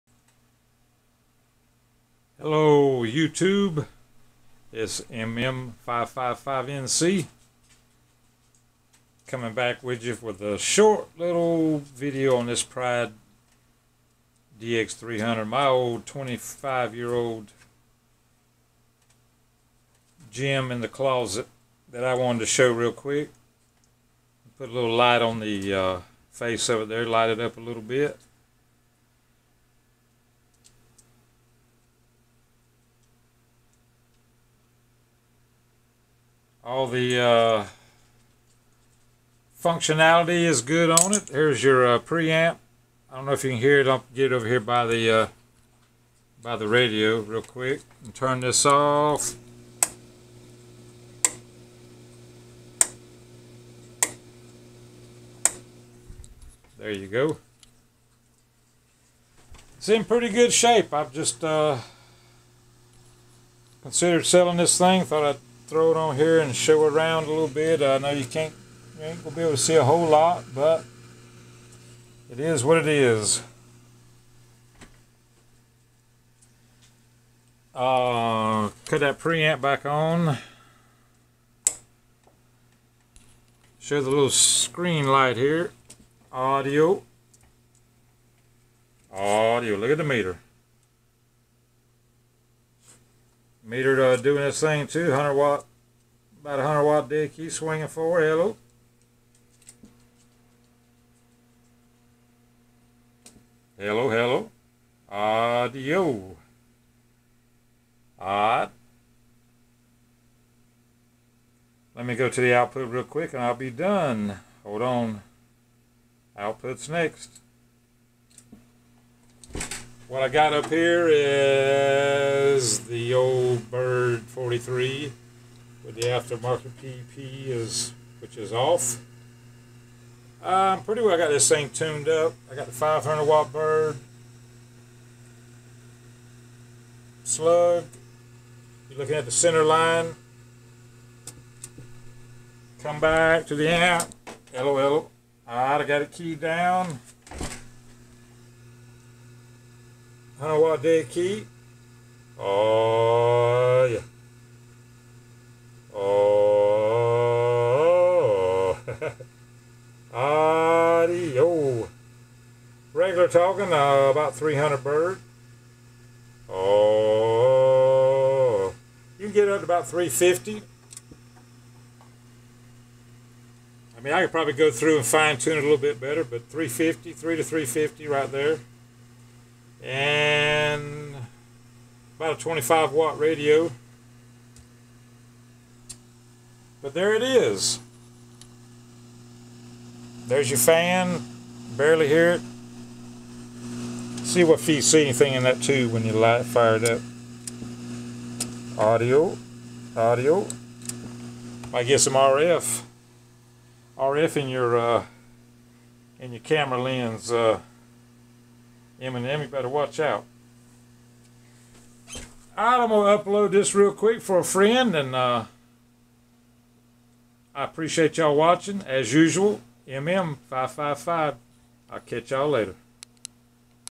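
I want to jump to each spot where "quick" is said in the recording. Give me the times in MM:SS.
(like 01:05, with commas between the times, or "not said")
00:22, 00:47, 01:53, 03:33.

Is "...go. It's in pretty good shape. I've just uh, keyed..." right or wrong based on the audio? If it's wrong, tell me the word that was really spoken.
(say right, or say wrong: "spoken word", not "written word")
wrong: "considered", not "keyed".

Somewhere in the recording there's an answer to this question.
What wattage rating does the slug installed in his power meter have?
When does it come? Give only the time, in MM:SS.
02:12.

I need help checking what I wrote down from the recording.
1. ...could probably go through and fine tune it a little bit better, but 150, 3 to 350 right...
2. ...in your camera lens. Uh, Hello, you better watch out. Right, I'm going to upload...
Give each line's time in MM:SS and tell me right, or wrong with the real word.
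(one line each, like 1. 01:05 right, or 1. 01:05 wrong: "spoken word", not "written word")
1. 02:54 wrong: "350", not "150"
2. 03:26 wrong: "Eminem", not "Hello".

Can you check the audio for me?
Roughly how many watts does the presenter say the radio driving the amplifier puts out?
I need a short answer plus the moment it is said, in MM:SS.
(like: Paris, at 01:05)
25 watts, at 03:02.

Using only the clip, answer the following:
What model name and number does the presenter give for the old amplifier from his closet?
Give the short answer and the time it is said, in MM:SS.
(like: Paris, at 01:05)
Pride DX300, at 00:12.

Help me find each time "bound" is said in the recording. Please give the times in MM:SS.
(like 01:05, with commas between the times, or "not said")
not said.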